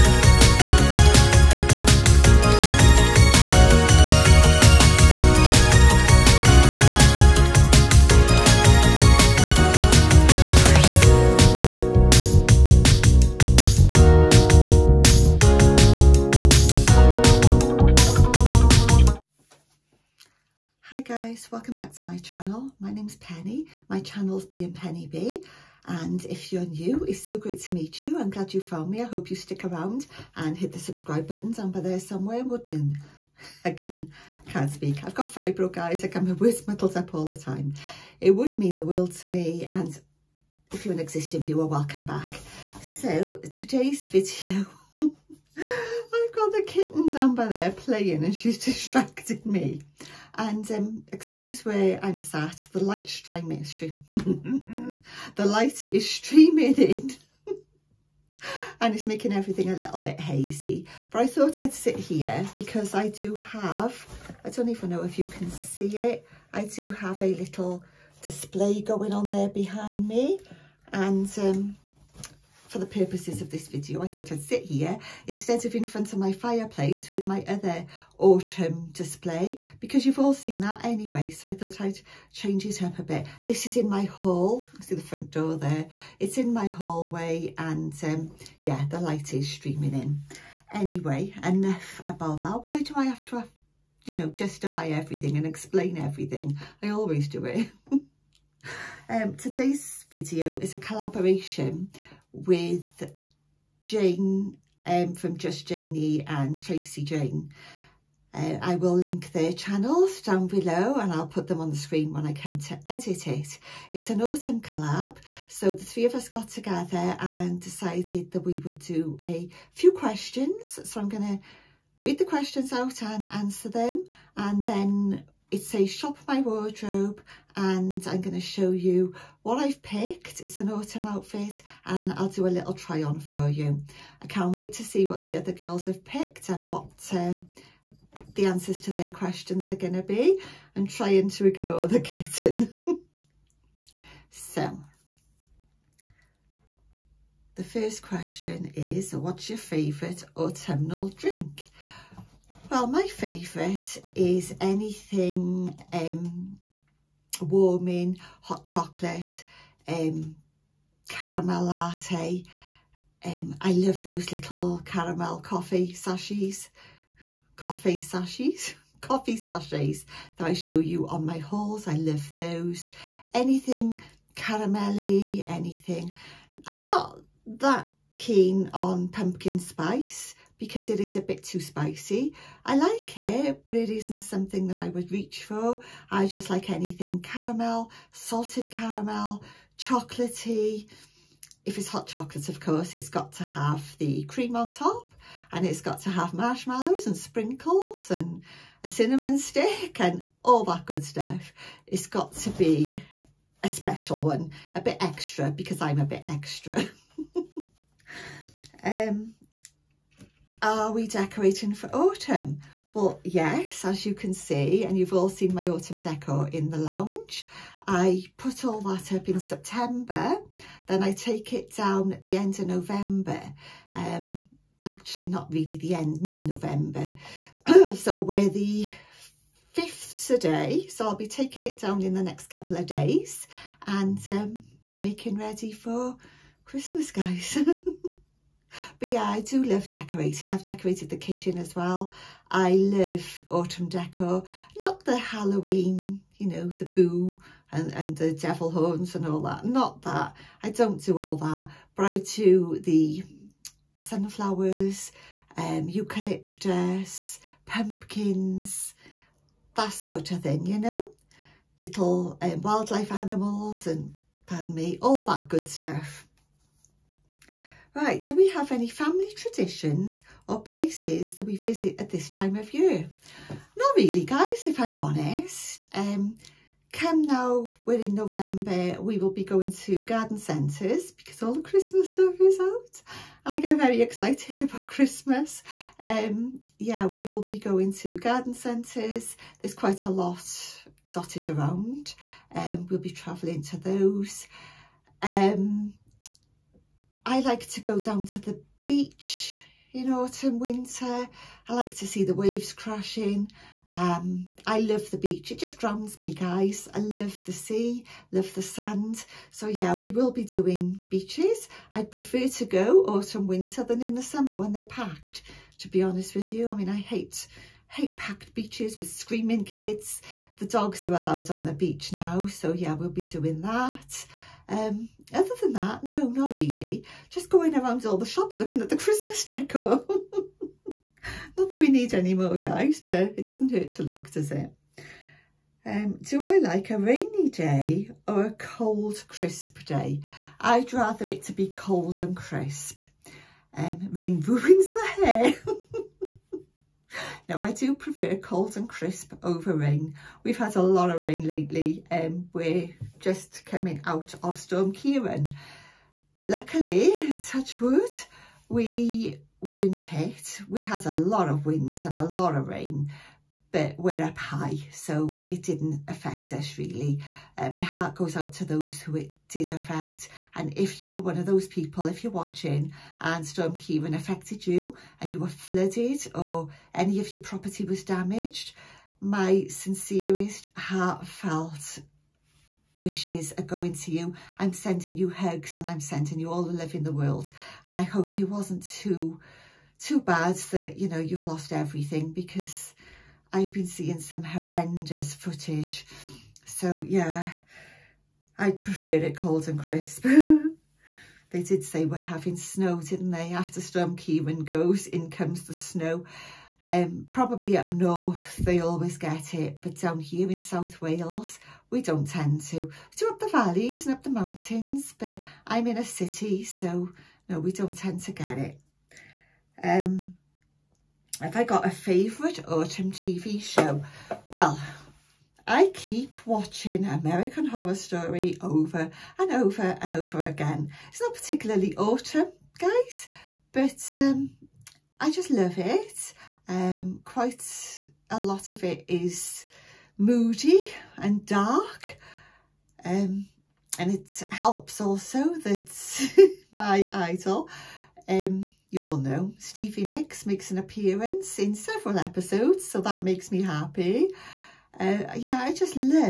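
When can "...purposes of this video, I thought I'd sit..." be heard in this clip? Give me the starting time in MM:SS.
01:13.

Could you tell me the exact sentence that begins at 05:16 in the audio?
I mean, I hate hate packed beaches with screaming kids.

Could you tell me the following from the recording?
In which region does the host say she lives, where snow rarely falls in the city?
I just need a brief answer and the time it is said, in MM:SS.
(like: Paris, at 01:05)
South Wales, at 06:50.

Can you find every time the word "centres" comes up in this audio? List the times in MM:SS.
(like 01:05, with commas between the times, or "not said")
04:40, 04:48.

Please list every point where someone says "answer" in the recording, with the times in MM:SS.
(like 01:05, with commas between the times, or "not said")
02:03, 02:18.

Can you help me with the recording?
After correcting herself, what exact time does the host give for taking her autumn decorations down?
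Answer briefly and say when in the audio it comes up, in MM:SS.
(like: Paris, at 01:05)
mid-November, at 03:46.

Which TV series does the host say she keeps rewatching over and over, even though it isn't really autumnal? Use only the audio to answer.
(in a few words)
American Horror Story.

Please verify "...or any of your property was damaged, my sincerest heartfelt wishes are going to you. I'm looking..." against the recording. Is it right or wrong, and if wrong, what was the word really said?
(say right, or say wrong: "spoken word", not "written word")
wrong: "sending", not "looking".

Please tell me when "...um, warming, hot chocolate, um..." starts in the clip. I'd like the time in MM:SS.
02:35.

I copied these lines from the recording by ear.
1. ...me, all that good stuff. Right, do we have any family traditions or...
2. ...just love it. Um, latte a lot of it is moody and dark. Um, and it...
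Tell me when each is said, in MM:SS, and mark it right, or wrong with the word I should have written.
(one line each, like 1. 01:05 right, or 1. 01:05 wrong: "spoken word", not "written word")
1. 04:24 right
2. 07:15 wrong: "quite", not "latte".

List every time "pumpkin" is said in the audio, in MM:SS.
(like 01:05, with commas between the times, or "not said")
02:59, 04:17.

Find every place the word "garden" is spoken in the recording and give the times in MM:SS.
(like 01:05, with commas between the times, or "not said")
04:40, 04:48.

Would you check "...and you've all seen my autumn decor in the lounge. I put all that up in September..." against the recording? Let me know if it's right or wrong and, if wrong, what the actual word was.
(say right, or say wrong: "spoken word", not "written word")
right.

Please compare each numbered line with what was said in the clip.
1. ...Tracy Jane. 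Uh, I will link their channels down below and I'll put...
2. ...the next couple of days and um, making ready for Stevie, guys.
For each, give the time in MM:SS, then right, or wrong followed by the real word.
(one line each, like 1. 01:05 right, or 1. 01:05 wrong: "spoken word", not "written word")
1. 01:46 right
2. 03:52 wrong: "Christmas", not "Stevie".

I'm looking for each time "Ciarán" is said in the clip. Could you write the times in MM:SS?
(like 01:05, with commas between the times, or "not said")
05:54, 06:13, 06:44.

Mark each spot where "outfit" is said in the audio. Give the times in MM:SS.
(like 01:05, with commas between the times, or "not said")
02:11.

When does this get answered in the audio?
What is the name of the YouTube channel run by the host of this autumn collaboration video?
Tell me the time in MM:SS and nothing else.
00:24.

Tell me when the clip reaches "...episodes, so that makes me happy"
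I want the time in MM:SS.
07:32.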